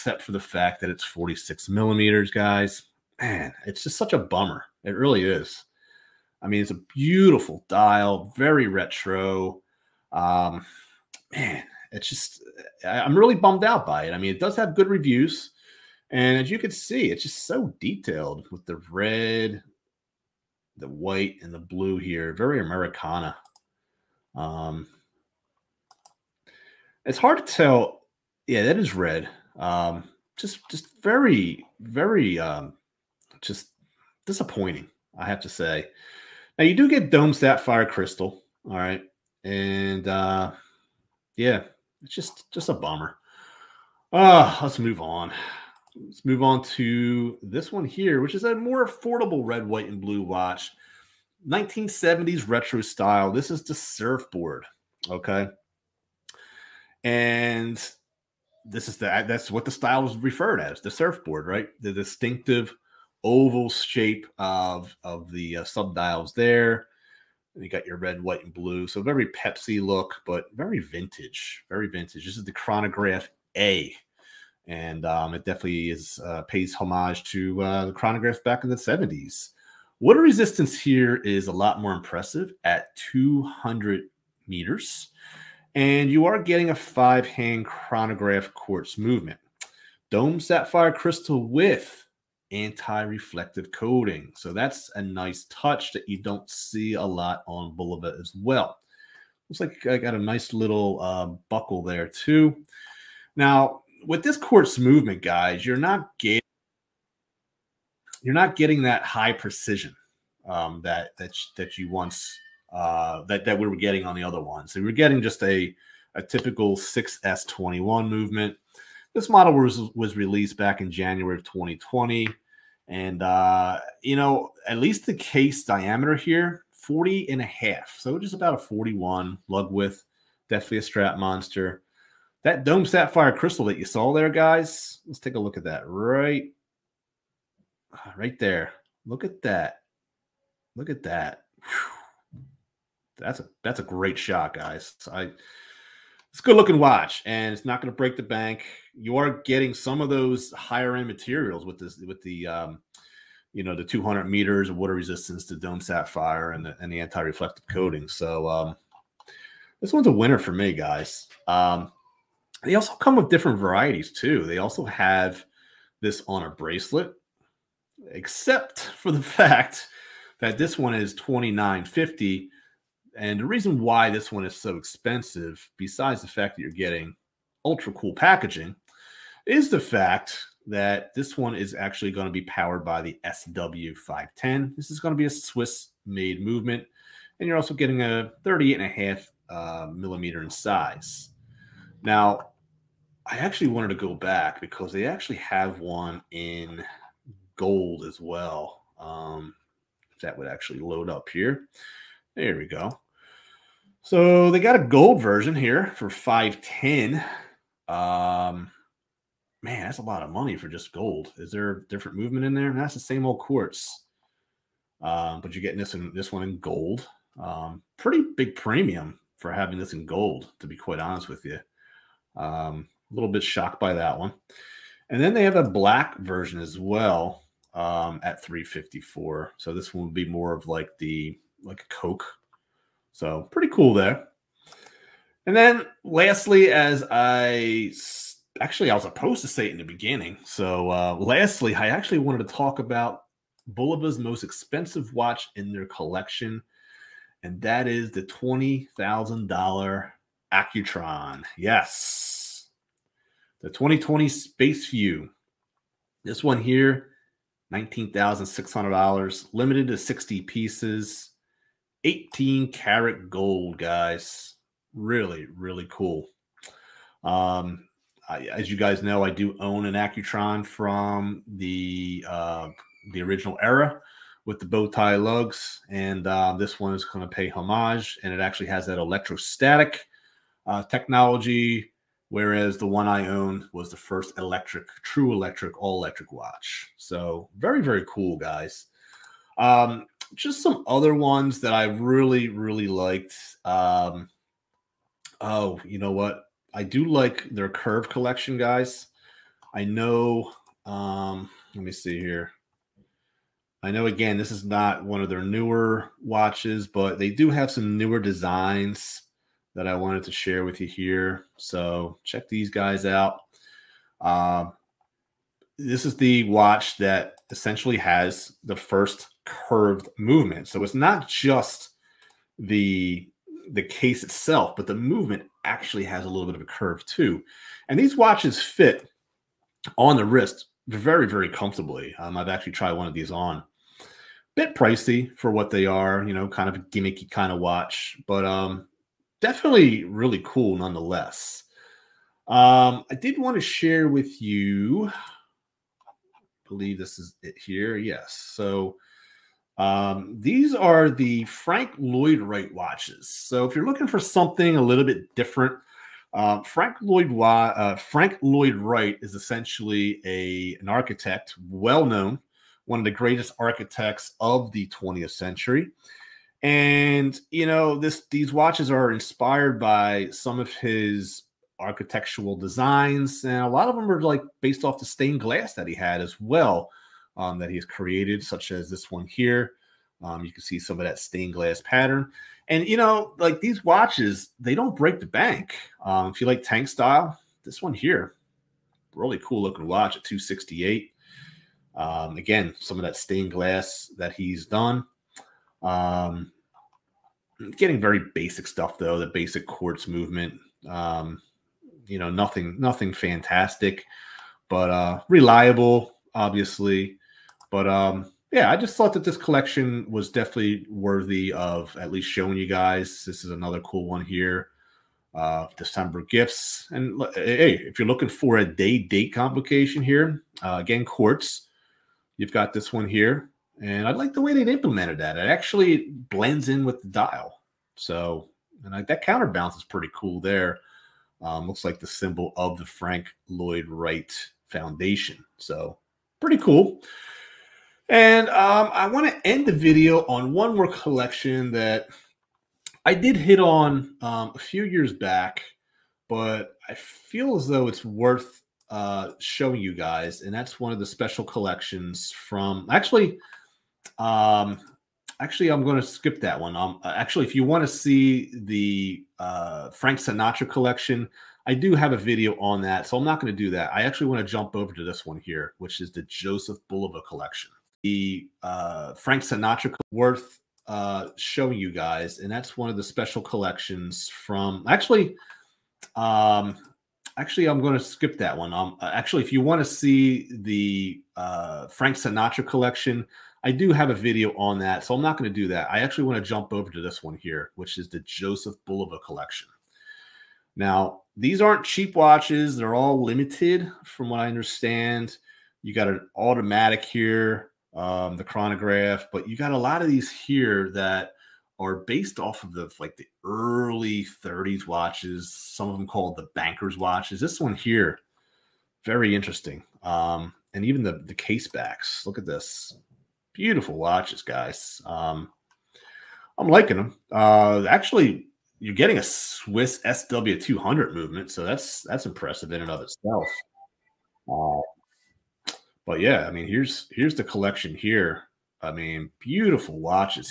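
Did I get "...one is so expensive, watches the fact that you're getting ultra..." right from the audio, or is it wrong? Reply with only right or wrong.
wrong.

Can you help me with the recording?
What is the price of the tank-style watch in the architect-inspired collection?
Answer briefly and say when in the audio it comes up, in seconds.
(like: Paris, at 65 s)
268, at 390 s.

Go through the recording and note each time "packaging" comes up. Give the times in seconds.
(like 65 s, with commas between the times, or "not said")
178 s.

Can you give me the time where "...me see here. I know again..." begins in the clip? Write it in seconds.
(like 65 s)
301 s.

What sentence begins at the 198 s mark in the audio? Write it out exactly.
Um, that would actually load up here.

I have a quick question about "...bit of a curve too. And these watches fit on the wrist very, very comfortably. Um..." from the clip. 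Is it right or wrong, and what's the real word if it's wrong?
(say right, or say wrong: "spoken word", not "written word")
right.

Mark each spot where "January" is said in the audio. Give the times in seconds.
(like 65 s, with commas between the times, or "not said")
120 s.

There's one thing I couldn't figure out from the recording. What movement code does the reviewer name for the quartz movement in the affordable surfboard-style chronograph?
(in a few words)
6S21.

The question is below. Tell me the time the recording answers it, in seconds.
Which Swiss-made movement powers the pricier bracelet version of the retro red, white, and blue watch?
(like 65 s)
183 s.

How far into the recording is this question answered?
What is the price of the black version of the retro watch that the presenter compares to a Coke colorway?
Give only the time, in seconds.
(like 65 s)
228 s.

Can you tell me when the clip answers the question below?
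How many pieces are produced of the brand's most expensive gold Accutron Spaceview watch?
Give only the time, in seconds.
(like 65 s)
259 s.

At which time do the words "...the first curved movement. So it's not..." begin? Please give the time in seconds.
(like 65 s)
318 s.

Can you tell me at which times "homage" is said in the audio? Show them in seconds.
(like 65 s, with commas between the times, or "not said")
76 s, 277 s.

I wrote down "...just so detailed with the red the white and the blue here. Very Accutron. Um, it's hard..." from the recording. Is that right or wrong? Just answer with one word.
wrong.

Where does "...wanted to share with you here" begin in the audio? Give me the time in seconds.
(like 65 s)
309 s.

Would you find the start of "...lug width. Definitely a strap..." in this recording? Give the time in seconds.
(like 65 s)
129 s.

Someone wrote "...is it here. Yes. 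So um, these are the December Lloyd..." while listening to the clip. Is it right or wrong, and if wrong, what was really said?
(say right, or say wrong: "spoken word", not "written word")
wrong: "Frank", not "December".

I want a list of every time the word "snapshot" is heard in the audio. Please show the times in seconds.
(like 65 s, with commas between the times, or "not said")
not said.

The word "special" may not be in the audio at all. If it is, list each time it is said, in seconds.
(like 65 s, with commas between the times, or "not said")
451 s, 473 s.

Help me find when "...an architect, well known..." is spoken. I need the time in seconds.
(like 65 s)
360 s.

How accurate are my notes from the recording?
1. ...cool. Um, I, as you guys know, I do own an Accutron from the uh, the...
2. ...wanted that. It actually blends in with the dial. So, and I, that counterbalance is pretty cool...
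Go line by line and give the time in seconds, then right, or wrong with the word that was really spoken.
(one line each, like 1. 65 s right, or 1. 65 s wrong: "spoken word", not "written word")
1. 265 s right
2. 424 s wrong: "implemented", not "wanted".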